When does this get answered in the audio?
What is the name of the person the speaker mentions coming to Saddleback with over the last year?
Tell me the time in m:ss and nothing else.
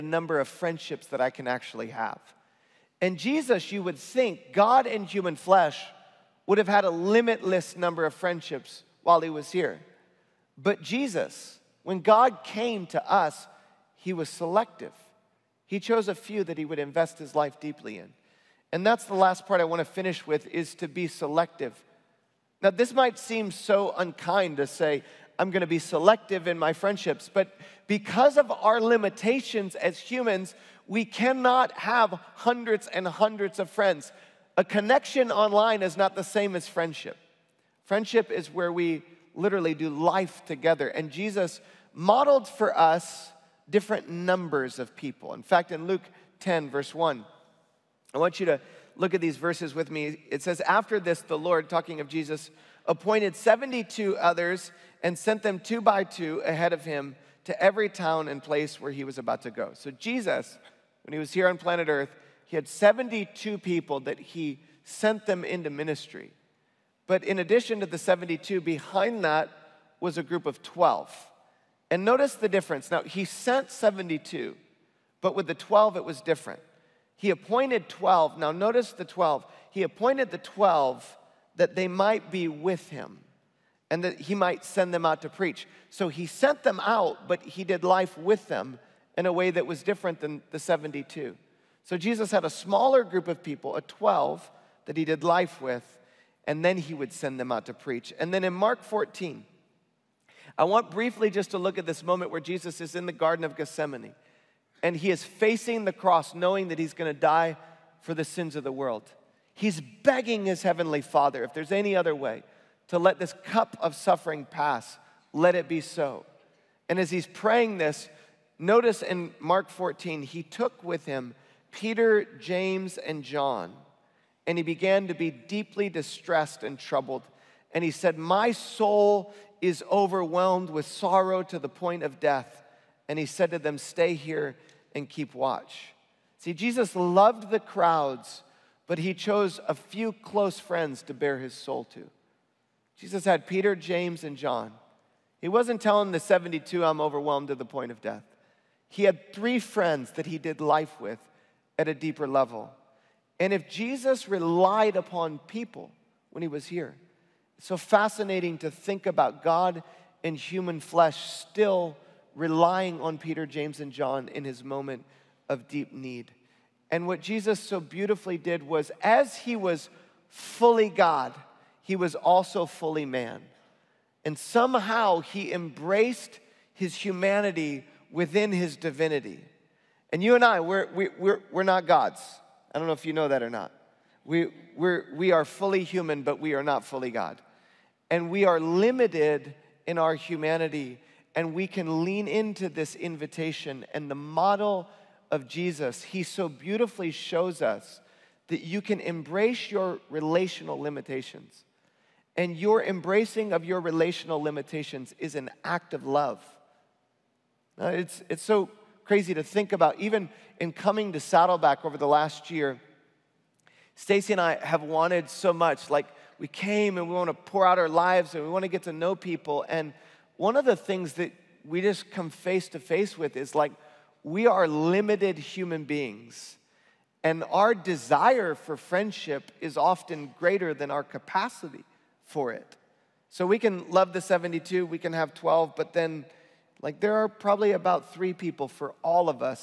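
3:33.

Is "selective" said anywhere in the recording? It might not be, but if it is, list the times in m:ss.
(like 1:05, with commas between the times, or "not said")
0:14, 0:21, 0:25.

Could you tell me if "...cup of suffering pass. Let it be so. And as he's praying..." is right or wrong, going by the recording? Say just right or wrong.
right.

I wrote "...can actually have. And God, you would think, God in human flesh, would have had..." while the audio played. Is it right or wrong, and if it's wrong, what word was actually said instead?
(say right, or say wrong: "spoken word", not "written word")
wrong: "Jesus", not "God".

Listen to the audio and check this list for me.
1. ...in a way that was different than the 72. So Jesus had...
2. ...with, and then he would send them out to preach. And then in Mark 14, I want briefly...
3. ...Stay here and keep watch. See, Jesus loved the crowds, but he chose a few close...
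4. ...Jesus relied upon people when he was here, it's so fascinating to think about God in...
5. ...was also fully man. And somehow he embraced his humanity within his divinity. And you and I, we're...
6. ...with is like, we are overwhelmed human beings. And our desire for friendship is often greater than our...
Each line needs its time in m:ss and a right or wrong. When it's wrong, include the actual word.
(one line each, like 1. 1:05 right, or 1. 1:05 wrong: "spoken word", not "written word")
1. 1:29 right
2. 1:35 right
3. 2:13 right
4. 2:33 right
5. 2:51 right
6. 3:43 wrong: "limited", not "overwhelmed".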